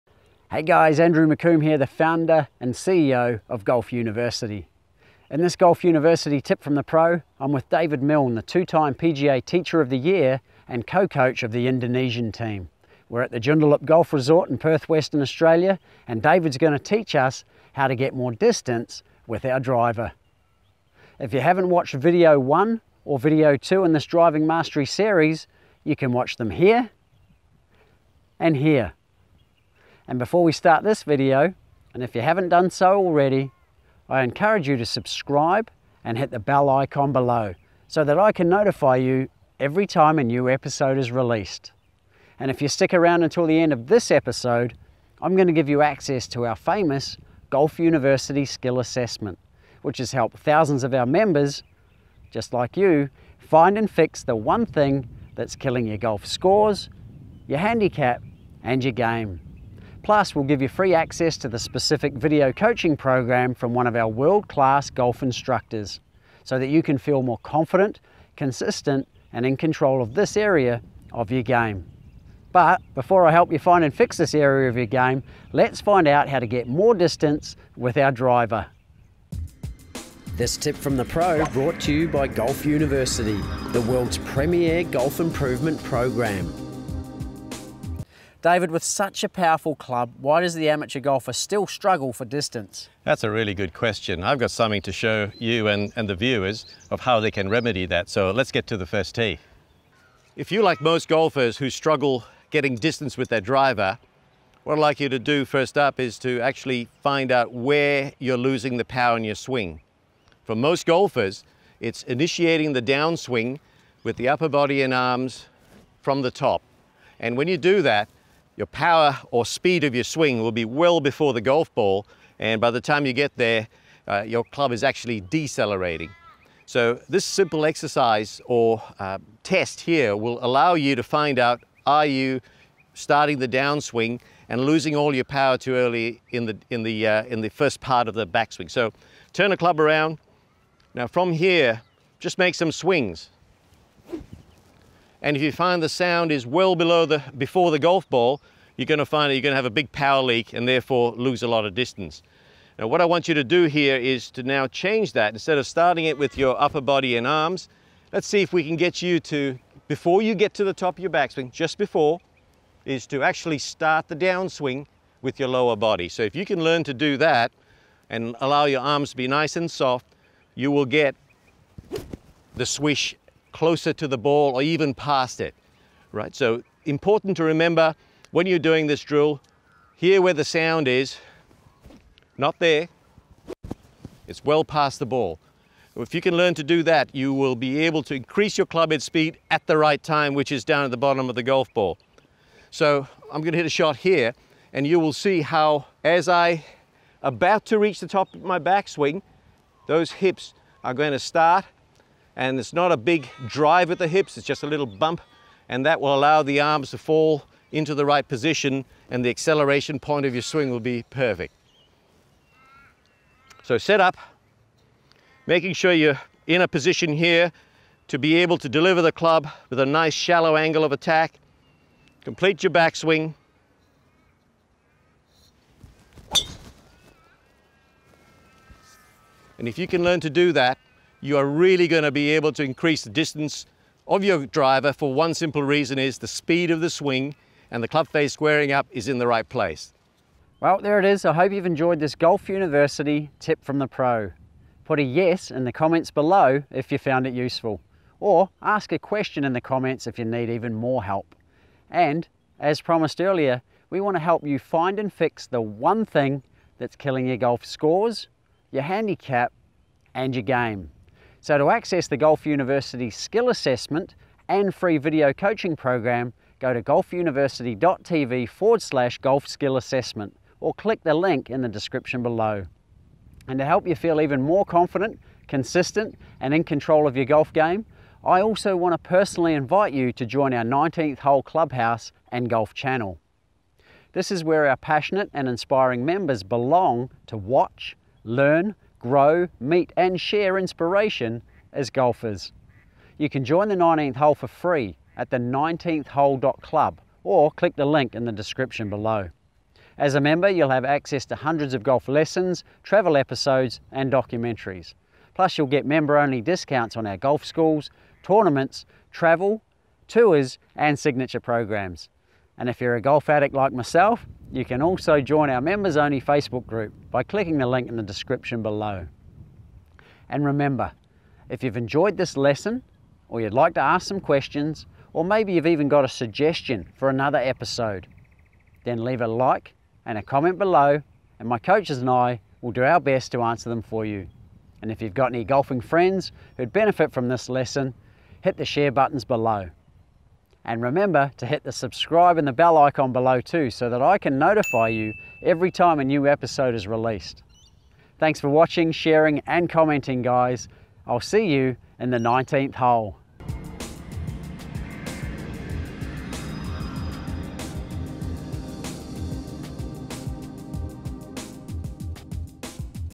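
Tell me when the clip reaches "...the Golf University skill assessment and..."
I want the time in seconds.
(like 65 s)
262 s.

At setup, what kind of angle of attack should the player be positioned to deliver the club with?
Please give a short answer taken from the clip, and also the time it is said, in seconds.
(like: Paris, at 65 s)
shallow, at 220 s.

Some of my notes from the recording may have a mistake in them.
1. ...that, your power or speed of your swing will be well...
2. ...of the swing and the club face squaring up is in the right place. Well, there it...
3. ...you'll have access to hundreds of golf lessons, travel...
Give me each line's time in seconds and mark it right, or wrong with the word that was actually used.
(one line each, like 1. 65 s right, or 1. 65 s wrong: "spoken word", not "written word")
1. 117 s right
2. 236 s right
3. 300 s right.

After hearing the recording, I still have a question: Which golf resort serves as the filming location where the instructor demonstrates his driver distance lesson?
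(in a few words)
Joondalup Golf Resort.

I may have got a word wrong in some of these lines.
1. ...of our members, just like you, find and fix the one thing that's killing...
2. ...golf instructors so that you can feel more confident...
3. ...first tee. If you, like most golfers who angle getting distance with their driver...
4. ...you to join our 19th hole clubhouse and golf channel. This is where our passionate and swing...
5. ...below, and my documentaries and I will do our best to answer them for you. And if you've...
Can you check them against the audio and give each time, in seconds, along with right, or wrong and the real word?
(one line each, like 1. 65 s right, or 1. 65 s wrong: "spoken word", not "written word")
1. 50 s right
2. 64 s right
3. 98 s wrong: "struggle", not "angle"
4. 279 s wrong: "inspiring", not "swing"
5. 330 s wrong: "coaches", not "documentaries".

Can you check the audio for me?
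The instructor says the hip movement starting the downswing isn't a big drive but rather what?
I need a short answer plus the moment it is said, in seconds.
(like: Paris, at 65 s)
a little bump, at 204 s.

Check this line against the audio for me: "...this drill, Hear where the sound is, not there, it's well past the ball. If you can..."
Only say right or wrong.
right.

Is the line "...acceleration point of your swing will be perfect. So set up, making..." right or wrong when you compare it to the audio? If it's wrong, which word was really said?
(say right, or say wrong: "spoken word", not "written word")
right.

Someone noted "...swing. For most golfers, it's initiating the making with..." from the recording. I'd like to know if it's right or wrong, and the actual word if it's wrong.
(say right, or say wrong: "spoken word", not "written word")
wrong: "downswing", not "making".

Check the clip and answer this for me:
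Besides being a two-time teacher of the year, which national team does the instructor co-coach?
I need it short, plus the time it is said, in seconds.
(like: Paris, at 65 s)
Indonesian team, at 11 s.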